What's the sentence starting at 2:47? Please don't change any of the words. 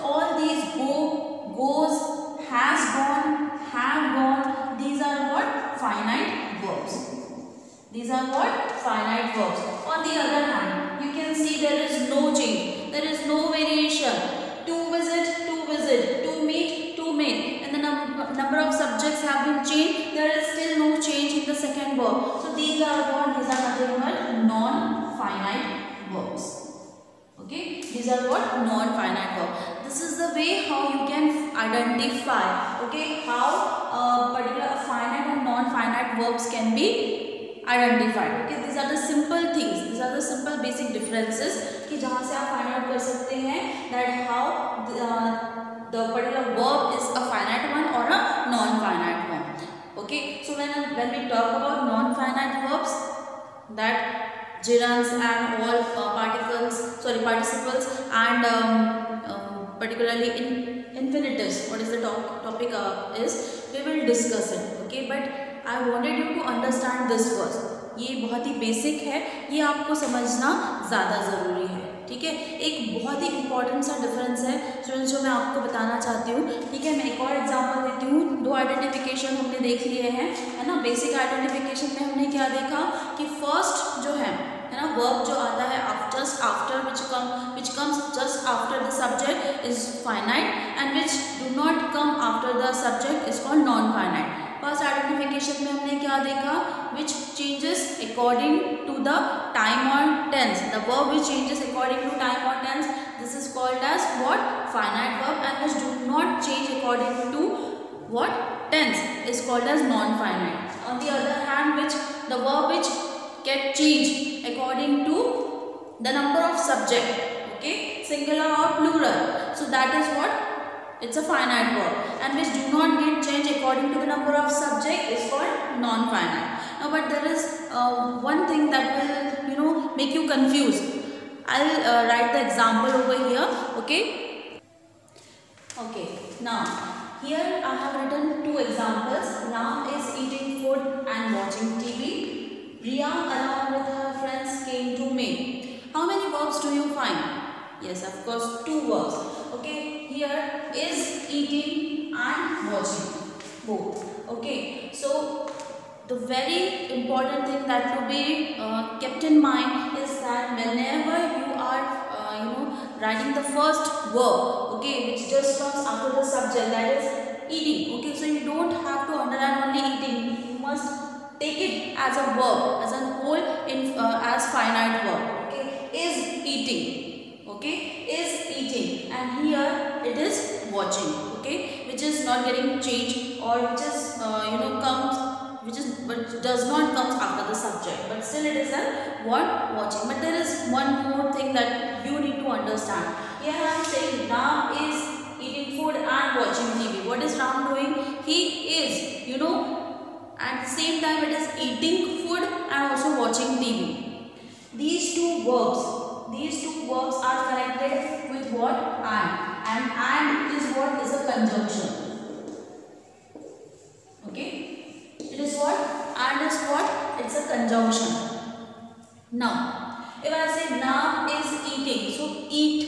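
Okay, so you don't have to underline only eating.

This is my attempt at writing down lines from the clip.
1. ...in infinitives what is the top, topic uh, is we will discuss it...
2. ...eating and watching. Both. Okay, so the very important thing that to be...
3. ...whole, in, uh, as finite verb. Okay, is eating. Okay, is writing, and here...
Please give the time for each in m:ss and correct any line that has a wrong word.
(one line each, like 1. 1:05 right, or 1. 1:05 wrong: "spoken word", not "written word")
1. 1:00 right
2. 2:31 right
3. 2:53 wrong: "eating", not "writing".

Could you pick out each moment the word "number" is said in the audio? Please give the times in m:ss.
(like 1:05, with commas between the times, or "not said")
1:56, 2:04.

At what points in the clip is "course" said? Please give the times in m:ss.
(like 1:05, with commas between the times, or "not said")
2:28.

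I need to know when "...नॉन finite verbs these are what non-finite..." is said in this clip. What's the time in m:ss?
0:24.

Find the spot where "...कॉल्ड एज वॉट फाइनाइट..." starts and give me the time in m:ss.
1:43.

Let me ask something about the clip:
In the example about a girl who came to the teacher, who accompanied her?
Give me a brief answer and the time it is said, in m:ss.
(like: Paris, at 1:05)
her friends, at 2:23.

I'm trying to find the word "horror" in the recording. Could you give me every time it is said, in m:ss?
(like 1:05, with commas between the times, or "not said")
not said.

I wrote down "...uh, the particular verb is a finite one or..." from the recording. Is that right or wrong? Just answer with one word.
right.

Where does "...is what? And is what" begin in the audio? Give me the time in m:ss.
3:35.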